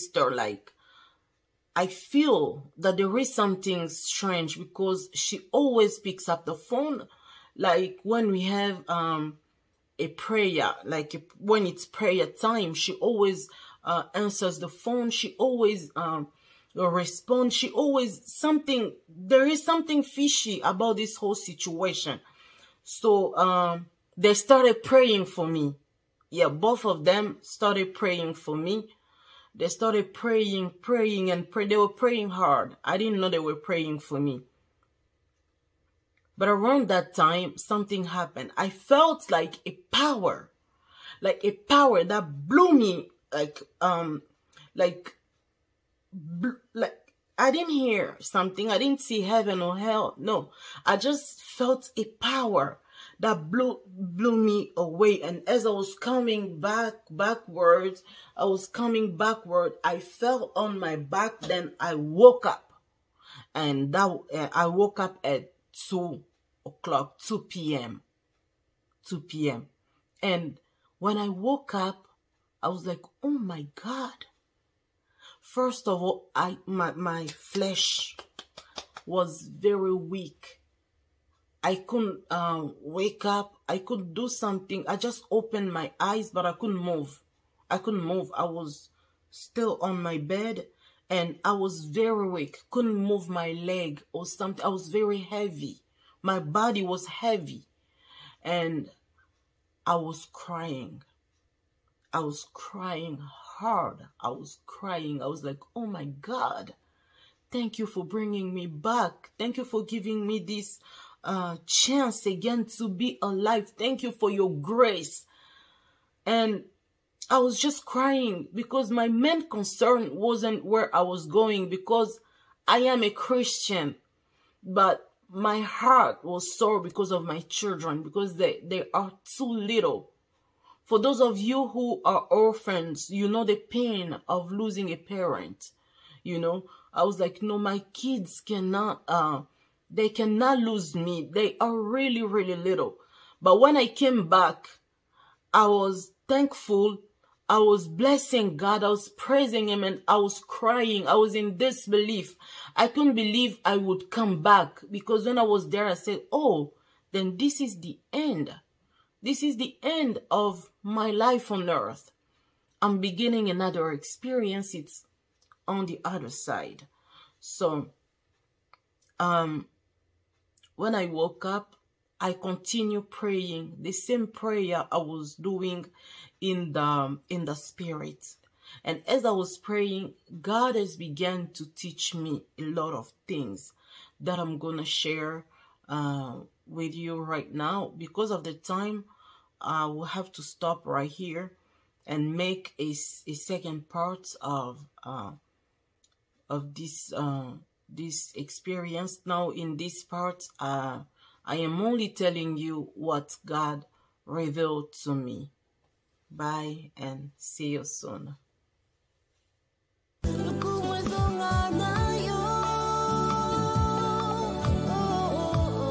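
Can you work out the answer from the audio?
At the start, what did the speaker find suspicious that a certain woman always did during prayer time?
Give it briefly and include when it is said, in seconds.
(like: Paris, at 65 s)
picks up the phone, at 5 s.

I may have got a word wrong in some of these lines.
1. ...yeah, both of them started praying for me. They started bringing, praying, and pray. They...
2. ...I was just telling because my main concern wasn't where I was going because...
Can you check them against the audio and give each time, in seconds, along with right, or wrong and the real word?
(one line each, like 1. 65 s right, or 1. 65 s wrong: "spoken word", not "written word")
1. 26 s wrong: "praying", not "bringing"
2. 117 s wrong: "crying", not "telling".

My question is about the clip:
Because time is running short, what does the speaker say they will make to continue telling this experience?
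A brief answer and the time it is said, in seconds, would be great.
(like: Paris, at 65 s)
a second part, at 193 s.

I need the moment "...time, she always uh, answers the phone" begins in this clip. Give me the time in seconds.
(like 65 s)
12 s.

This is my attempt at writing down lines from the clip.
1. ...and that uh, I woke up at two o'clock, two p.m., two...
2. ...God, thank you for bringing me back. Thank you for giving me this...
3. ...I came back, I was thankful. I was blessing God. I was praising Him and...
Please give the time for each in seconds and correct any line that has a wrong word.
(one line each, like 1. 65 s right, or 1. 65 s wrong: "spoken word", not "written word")
1. 63 s right
2. 106 s right
3. 143 s right.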